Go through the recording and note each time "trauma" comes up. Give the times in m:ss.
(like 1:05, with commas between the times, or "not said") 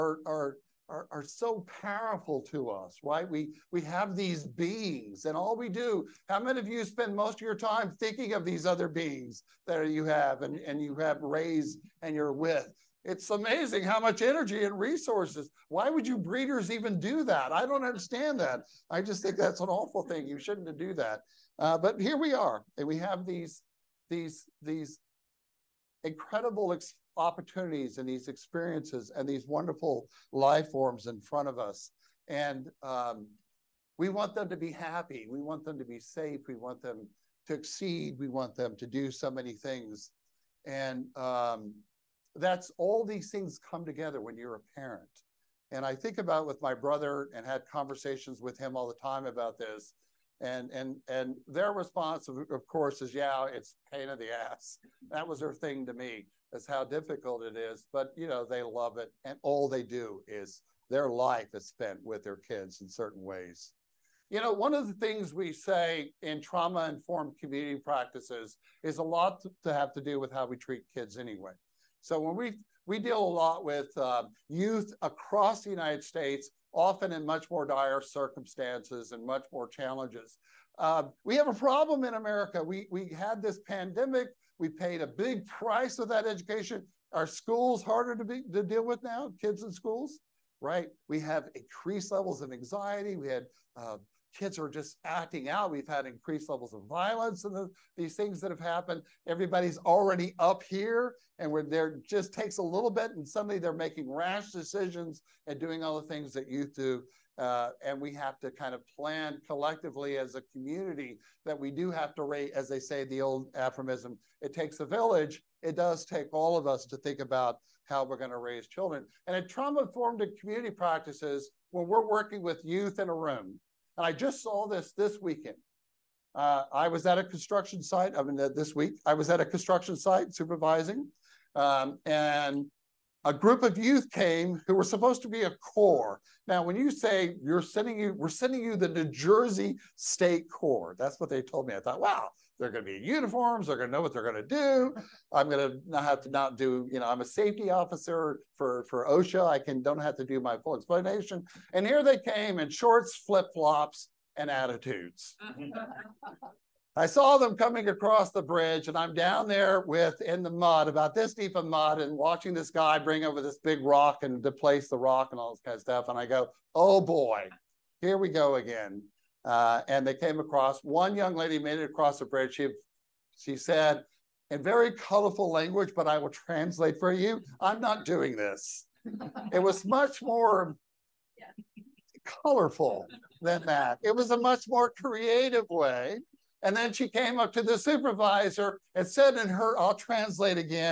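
1:06, 1:59.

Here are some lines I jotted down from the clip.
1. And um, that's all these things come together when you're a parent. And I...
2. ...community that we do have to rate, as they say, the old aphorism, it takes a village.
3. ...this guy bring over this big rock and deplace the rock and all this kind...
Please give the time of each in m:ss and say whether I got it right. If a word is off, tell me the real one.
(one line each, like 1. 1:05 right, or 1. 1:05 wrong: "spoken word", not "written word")
1. 0:40 right
2. 1:50 right
3. 2:42 right.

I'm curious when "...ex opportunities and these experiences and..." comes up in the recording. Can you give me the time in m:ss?
0:26.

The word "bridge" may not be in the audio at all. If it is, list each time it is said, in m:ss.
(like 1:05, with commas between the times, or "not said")
2:38, 2:52.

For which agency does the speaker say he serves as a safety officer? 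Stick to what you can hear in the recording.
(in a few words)
OSHA.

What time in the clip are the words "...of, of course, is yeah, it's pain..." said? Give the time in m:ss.
0:52.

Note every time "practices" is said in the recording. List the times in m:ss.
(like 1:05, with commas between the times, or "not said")
1:07, 2:00.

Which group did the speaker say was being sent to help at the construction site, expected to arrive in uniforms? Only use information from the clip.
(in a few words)
New Jersey State Corps.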